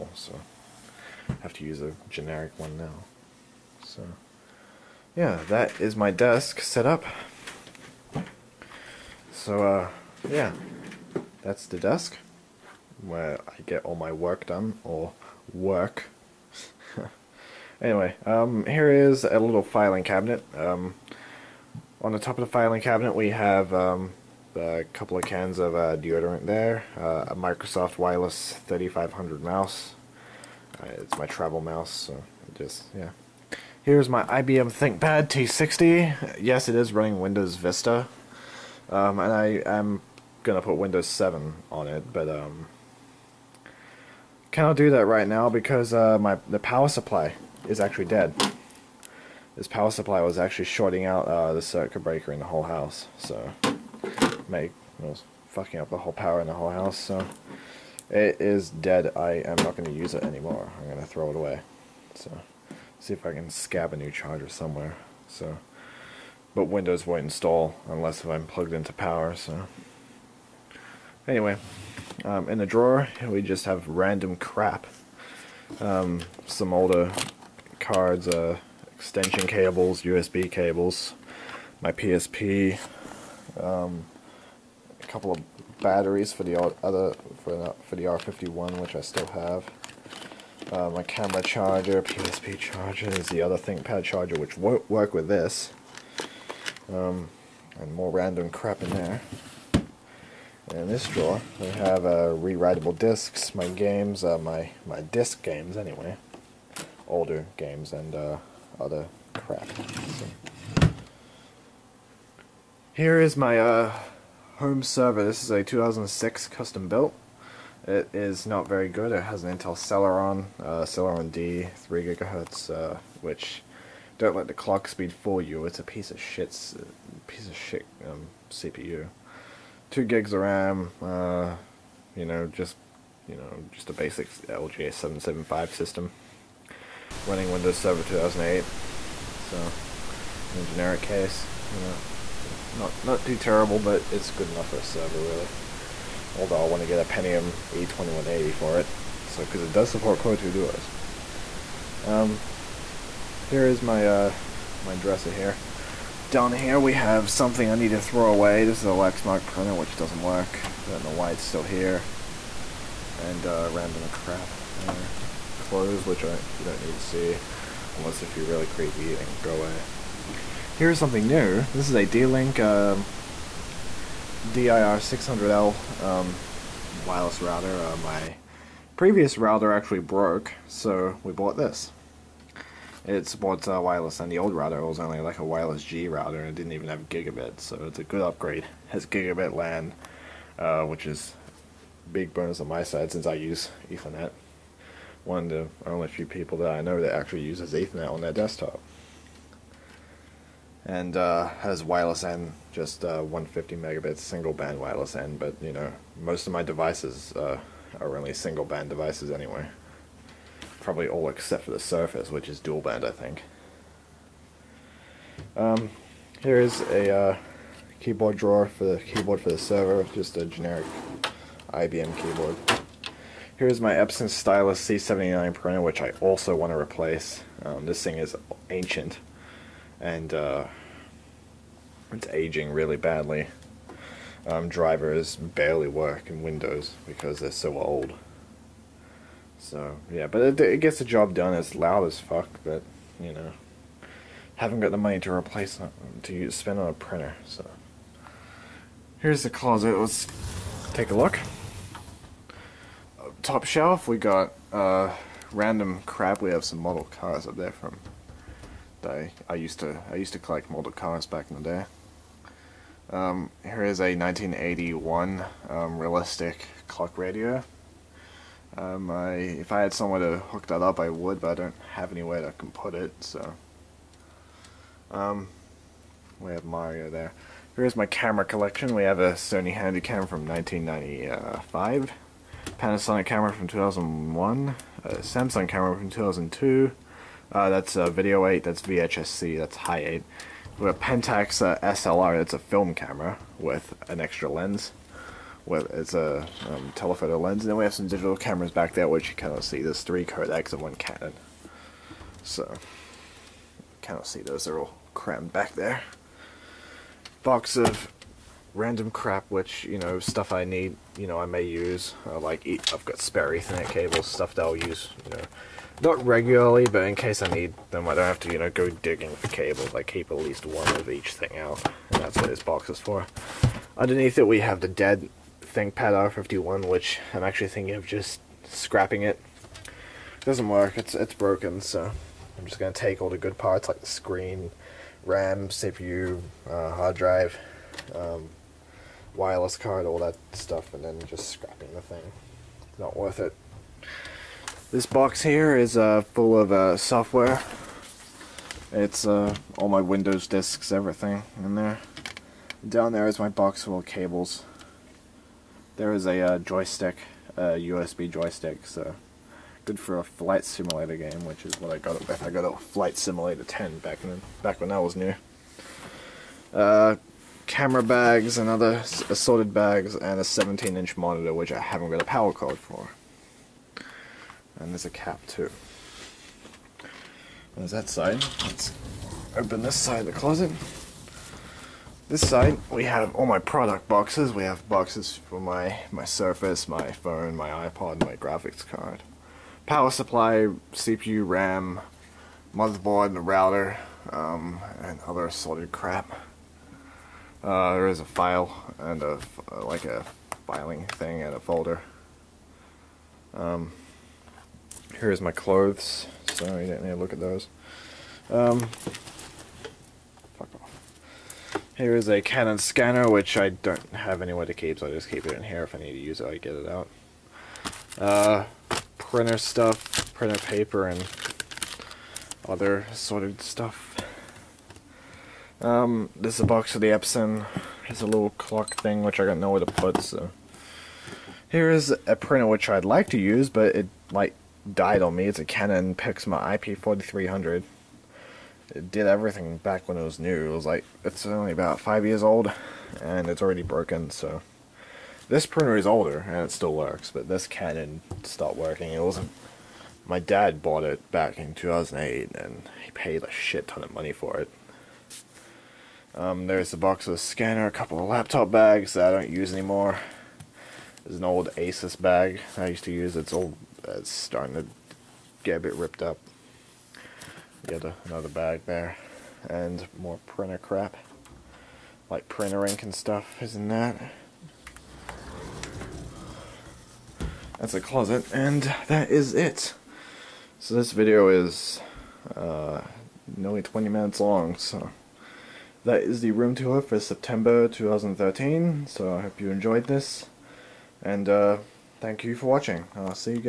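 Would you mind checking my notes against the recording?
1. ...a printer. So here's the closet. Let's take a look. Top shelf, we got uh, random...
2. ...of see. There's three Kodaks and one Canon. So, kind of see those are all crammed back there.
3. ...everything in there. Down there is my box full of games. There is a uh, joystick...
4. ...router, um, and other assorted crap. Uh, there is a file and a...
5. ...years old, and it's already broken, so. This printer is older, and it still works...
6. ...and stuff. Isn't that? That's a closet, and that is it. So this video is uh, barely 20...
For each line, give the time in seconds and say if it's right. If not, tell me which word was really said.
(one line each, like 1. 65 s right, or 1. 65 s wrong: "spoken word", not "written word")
1. 246 s right
2. 299 s right
3. 350 s wrong: "cables", not "games"
4. 393 s right
5. 442 s right
6. 473 s wrong: "nearly", not "barely".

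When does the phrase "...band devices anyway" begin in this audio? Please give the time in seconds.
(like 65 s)
208 s.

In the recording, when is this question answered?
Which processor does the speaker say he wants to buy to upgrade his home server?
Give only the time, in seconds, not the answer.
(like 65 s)
147 s.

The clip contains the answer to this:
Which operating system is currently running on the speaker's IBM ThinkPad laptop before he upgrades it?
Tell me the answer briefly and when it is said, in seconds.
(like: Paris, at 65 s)
Windows Vista, at 37 s.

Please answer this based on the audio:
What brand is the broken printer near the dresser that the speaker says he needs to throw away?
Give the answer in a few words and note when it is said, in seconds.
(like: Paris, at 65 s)
Lexmark, at 158 s.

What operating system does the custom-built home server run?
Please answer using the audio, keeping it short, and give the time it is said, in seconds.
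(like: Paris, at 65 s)
Windows Server 2008, at 137 s.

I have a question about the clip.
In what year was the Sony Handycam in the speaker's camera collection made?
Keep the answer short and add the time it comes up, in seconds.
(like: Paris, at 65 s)
1995, at 280 s.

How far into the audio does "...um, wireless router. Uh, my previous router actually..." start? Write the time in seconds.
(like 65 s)
176 s.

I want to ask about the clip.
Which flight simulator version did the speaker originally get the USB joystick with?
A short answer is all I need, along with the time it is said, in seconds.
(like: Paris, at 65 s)
Flight Simulator 10, at 362 s.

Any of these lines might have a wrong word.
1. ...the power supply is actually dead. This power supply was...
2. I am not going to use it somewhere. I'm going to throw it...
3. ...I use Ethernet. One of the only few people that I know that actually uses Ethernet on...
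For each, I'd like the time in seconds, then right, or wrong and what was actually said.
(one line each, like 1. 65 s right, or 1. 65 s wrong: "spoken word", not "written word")
1. 46 s right
2. 59 s wrong: "anymore", not "somewhere"
3. 193 s right.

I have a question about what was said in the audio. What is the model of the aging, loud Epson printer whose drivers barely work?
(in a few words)
Stylus C79.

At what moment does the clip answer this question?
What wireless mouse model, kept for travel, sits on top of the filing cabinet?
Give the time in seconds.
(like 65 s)
27 s.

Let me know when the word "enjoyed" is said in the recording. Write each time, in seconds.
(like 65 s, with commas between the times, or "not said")
489 s.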